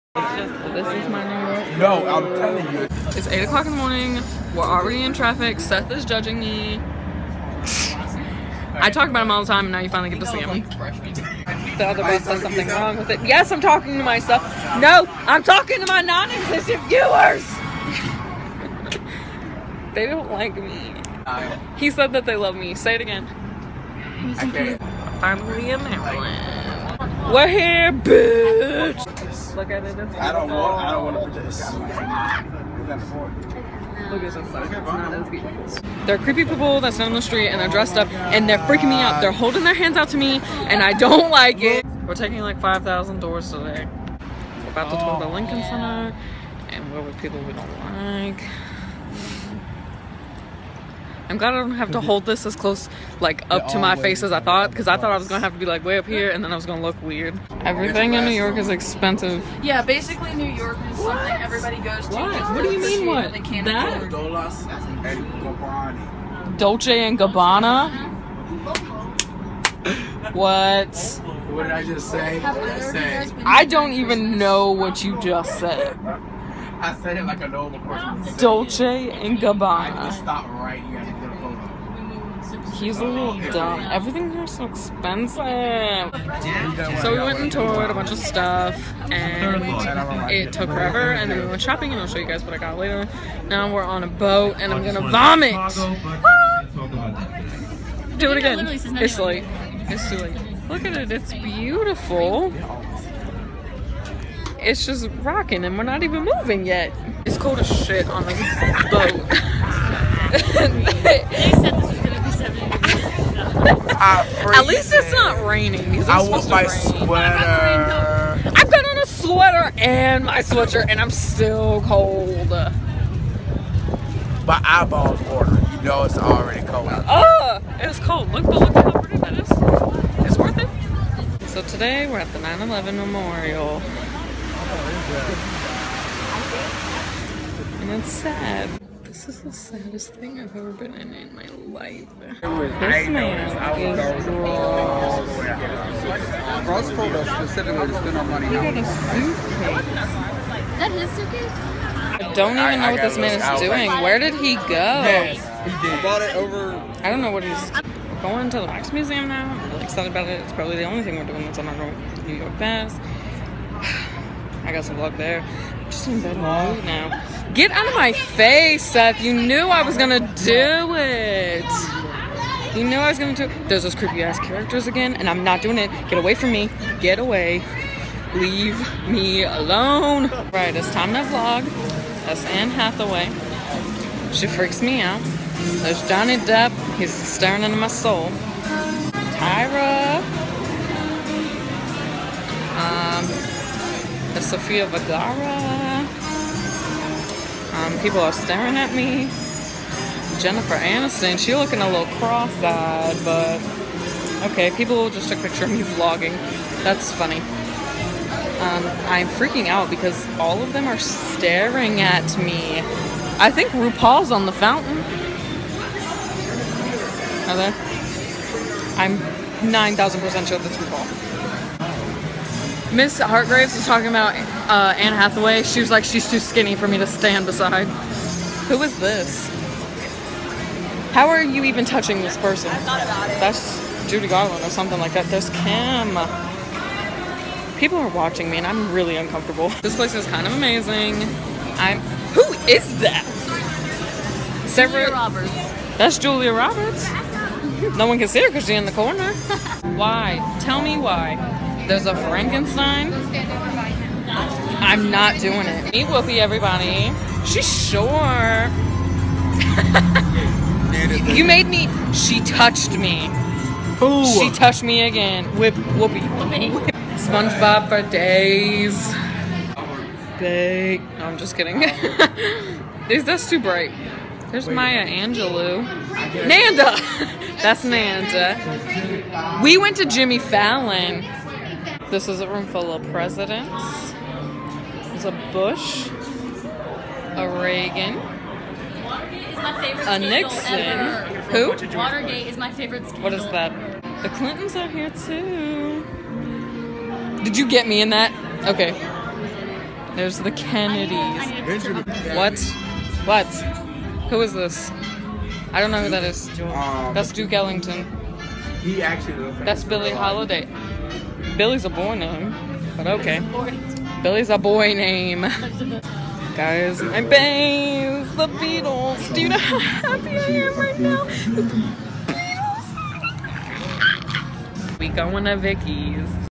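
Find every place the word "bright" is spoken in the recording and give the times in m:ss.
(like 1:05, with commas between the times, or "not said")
4:33.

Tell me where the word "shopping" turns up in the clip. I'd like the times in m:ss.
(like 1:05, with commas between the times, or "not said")
1:31.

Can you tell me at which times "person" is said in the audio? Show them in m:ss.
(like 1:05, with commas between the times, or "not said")
1:17, 3:52.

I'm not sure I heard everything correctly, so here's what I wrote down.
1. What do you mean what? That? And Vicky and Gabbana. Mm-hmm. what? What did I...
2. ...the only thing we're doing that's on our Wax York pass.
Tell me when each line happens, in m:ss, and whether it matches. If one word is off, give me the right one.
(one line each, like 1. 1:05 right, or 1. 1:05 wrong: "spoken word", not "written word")
1. 1:02 wrong: "Dolce", not "Vicky"
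2. 2:40 wrong: "New", not "Wax".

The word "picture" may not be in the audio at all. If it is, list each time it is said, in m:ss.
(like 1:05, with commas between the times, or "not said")
3:25.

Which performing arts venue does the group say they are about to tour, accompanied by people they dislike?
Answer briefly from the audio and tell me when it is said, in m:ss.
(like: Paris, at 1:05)
Lincoln Center, at 0:45.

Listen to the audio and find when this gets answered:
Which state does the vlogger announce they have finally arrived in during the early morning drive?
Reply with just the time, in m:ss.
0:25.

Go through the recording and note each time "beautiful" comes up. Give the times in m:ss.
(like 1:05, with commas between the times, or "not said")
1:41.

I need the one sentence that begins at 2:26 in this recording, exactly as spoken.
Ross told us specifically to spend our money.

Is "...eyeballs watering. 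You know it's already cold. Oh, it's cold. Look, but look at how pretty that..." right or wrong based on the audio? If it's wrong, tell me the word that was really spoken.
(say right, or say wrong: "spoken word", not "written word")
right.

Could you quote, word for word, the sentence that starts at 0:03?
It's 8 o'clock in the morning.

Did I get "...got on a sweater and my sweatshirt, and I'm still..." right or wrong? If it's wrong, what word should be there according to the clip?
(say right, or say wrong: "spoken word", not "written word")
right.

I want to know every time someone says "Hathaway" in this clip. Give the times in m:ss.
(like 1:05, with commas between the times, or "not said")
3:02, 3:45.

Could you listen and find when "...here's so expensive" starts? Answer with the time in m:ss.
1:24.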